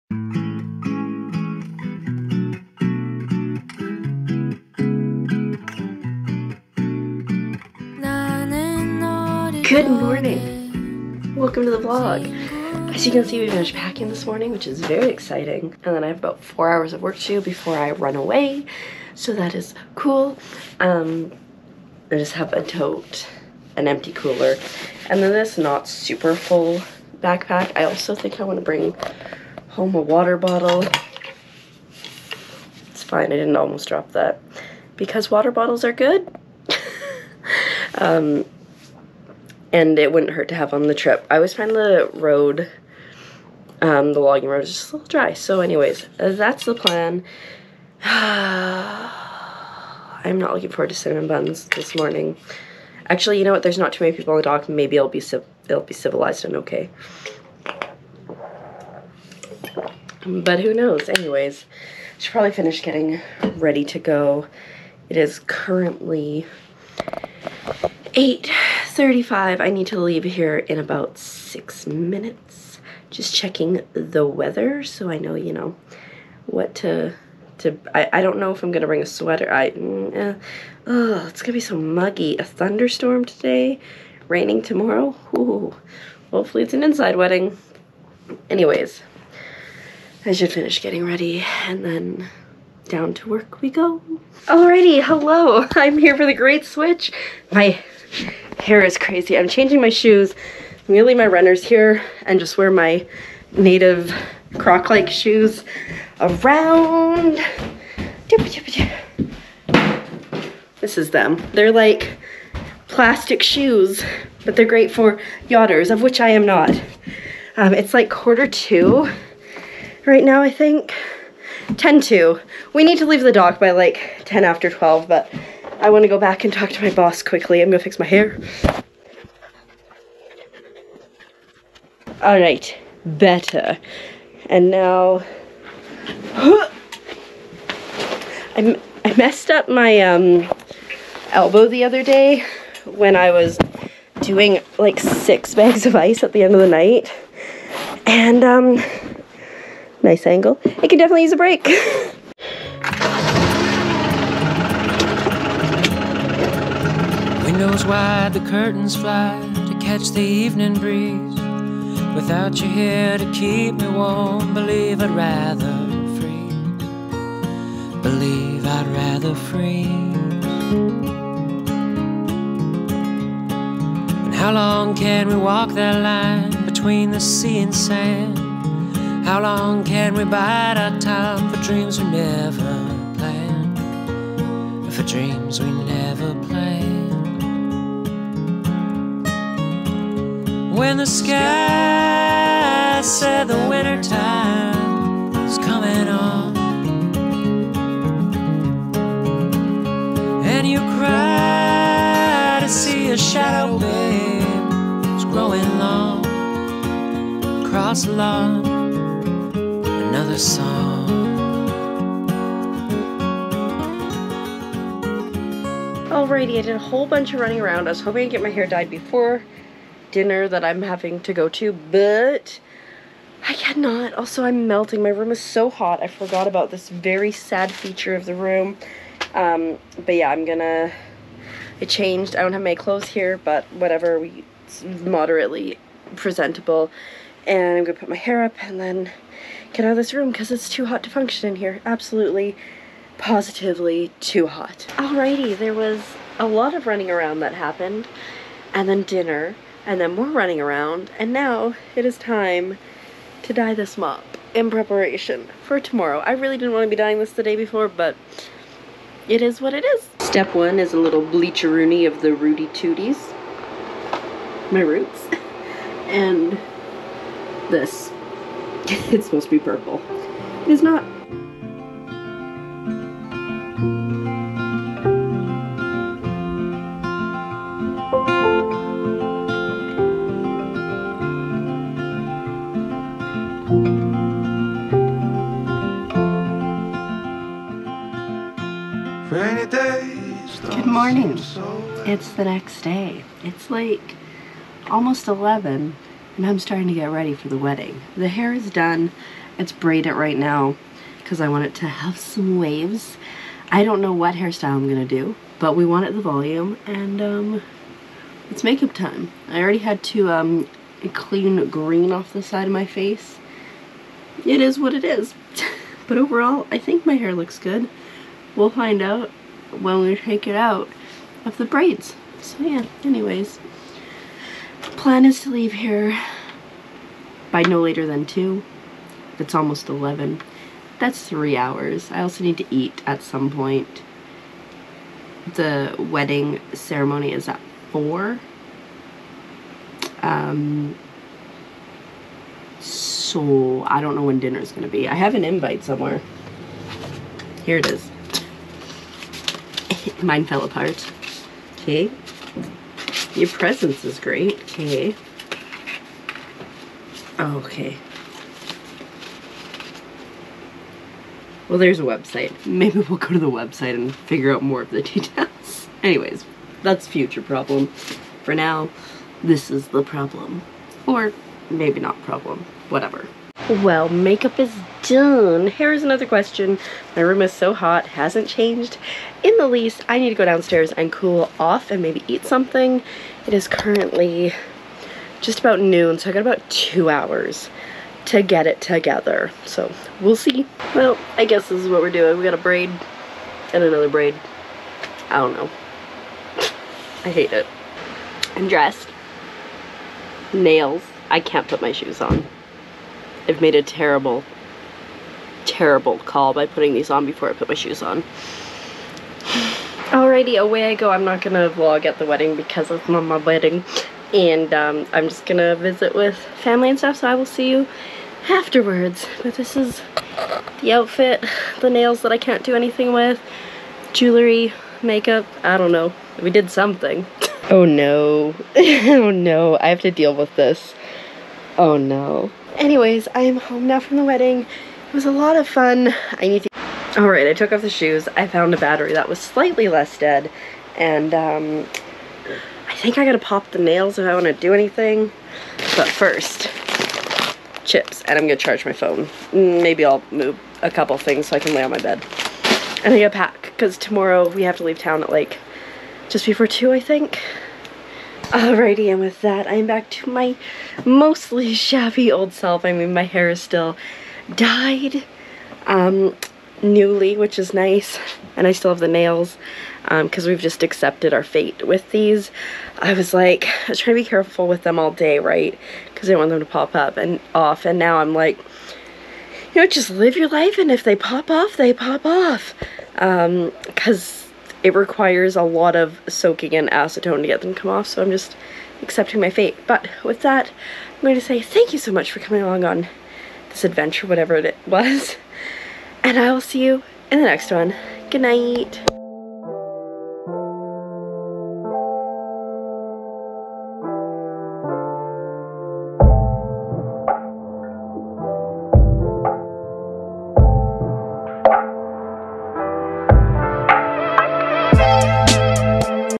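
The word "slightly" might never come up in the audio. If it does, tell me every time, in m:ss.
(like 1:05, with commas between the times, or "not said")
7:19.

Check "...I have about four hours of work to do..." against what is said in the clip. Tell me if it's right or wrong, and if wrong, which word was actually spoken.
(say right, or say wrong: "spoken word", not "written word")
right.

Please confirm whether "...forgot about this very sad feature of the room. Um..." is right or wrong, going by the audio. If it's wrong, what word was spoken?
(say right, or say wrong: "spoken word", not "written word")
right.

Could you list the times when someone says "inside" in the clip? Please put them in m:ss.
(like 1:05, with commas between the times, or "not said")
1:26.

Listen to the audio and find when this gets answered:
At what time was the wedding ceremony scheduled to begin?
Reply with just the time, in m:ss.
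5:35.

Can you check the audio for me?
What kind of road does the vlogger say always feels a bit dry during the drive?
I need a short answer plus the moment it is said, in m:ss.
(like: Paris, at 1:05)
Logging road, at 0:44.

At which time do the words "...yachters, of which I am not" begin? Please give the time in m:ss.
1:55.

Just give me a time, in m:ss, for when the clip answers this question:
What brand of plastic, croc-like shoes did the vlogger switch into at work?
1:43.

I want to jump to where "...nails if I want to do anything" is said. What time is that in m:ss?
7:23.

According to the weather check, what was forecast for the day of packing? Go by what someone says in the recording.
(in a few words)
A thunderstorm.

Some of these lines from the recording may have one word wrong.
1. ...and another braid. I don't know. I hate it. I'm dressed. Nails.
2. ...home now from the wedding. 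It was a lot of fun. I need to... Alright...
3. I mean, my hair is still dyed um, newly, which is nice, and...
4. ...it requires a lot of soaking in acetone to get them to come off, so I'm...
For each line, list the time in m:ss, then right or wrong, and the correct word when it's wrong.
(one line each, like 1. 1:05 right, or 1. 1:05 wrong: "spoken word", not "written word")
1. 6:33 right
2. 7:13 right
3. 7:42 right
4. 8:04 right.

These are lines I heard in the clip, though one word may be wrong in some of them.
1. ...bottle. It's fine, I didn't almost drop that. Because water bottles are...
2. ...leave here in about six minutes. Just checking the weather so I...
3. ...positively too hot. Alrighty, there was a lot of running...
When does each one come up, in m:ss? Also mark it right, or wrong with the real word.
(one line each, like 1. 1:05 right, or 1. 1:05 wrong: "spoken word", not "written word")
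1. 0:30 right
2. 1:09 right
3. 4:03 right.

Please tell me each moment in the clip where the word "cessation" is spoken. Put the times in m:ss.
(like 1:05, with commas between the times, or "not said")
not said.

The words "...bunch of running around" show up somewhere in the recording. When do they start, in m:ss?
3:37.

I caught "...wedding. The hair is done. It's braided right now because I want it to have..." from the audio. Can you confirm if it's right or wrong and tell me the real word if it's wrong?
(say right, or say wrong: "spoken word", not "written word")
right.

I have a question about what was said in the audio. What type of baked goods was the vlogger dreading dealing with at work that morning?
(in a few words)
Cinnamon buns.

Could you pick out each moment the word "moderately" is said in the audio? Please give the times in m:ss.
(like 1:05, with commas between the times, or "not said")
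3:55.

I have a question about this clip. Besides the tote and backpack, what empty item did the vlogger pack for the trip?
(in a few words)
Cooler.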